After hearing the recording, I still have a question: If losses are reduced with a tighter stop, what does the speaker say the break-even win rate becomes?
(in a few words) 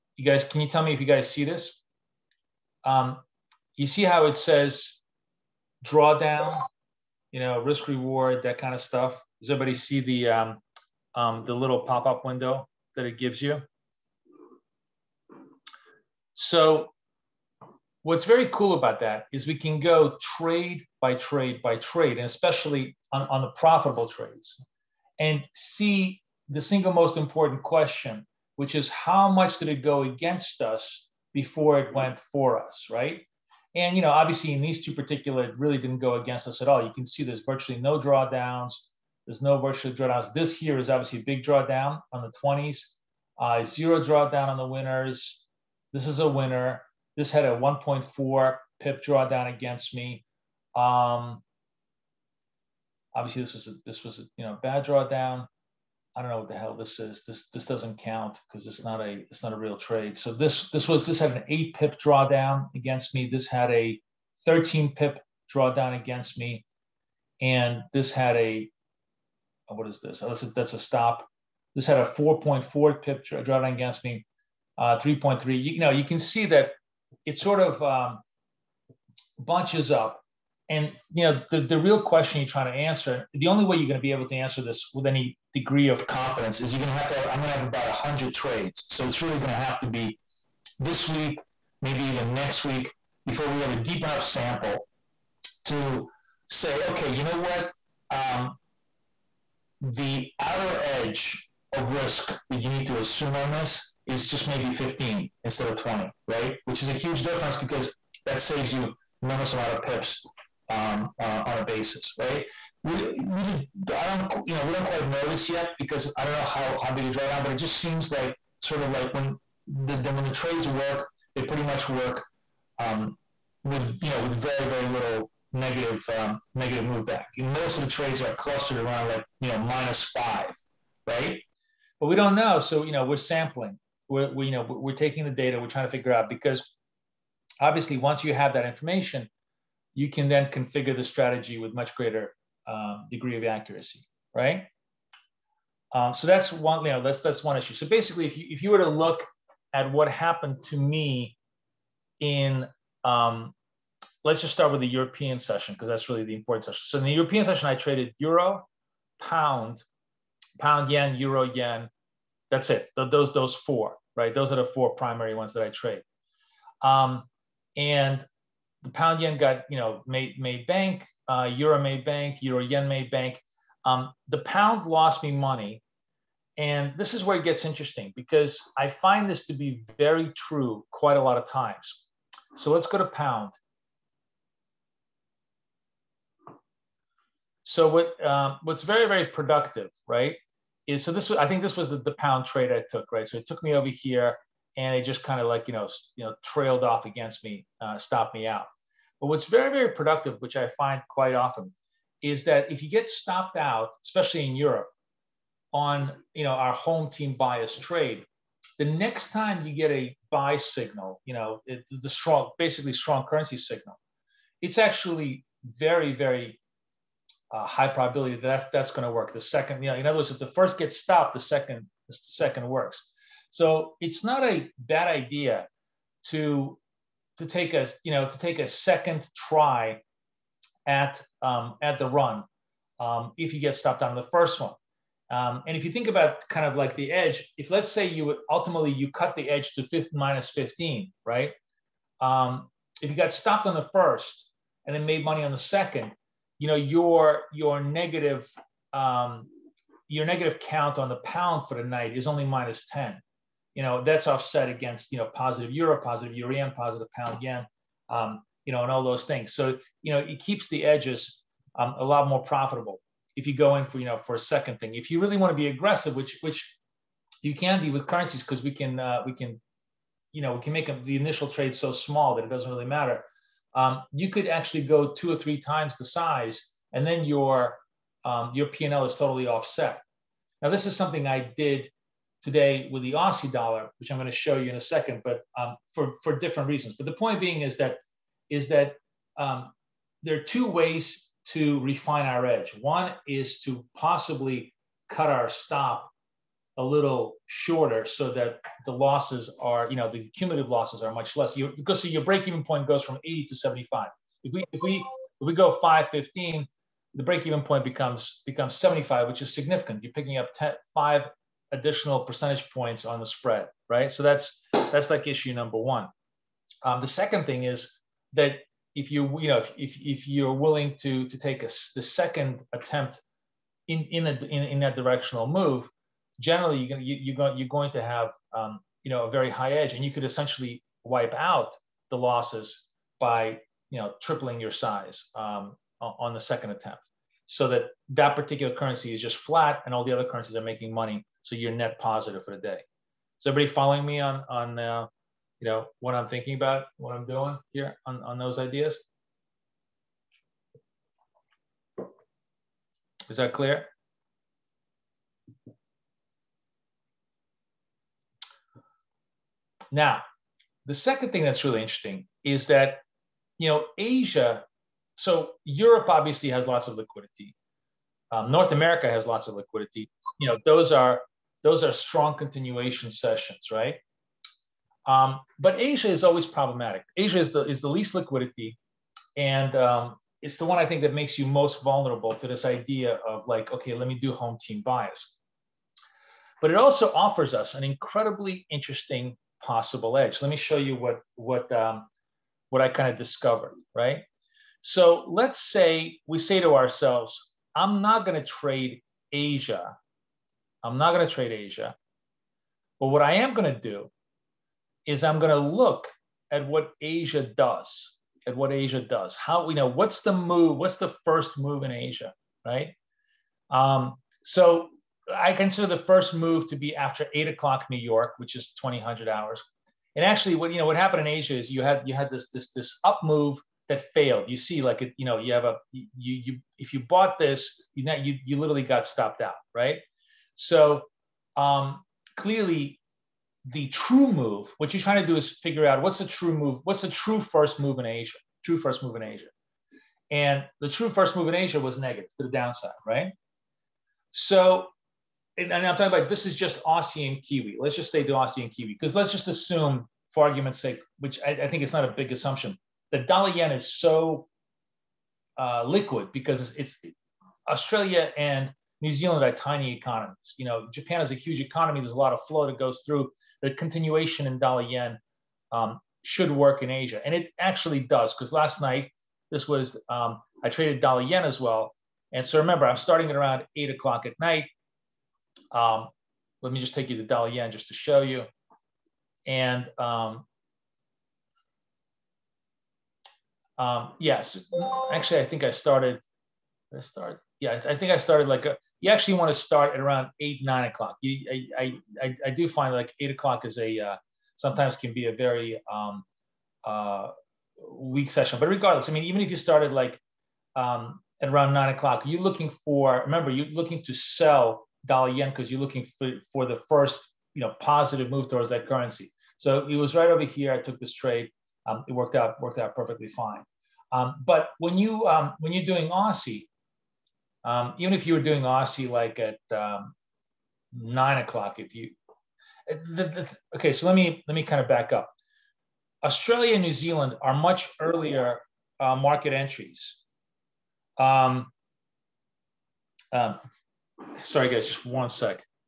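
75.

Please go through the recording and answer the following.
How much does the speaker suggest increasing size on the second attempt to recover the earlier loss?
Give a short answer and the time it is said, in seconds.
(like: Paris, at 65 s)
tripling, at 334 s.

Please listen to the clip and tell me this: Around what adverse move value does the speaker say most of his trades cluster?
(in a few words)
minus 5.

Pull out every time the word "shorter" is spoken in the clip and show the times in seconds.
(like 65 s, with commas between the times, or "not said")
297 s.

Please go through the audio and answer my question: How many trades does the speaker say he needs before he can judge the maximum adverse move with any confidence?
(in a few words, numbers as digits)
100.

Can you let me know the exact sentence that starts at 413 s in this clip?
Um, so I consider the first move to be after eight o'clock New York, which is 2000 hours.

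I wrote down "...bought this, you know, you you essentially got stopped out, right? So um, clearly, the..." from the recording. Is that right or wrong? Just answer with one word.
wrong.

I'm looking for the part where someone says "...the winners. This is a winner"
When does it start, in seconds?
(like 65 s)
44 s.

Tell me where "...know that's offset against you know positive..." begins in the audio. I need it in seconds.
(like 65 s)
253 s.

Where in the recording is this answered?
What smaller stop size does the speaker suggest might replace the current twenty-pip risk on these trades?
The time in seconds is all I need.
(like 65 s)
104 s.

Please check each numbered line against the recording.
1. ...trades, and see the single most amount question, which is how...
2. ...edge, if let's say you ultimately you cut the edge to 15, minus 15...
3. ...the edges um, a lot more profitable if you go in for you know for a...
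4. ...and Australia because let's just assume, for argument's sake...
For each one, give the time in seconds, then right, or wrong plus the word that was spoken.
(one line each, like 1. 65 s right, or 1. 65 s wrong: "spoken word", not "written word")
1. 24 s wrong: "important", not "amount"
2. 237 s right
3. 260 s right
4. 448 s wrong: "Kiwi", not "Australia".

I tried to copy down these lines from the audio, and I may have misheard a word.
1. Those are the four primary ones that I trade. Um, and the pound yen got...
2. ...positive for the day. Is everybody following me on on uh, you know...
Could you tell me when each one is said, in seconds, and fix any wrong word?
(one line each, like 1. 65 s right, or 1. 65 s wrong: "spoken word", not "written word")
1. 164 s right
2. 342 s right.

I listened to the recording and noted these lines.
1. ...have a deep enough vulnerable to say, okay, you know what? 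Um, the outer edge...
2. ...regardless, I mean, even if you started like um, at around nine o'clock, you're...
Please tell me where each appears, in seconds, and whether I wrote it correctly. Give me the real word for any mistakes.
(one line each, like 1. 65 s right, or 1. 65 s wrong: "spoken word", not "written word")
1. 93 s wrong: "sample", not "vulnerable"
2. 498 s right.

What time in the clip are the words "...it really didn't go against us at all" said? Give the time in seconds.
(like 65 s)
35 s.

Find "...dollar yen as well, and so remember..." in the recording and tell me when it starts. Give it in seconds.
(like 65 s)
471 s.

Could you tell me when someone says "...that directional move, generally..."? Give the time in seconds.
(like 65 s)
324 s.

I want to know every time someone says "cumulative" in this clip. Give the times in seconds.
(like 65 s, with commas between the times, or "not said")
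300 s.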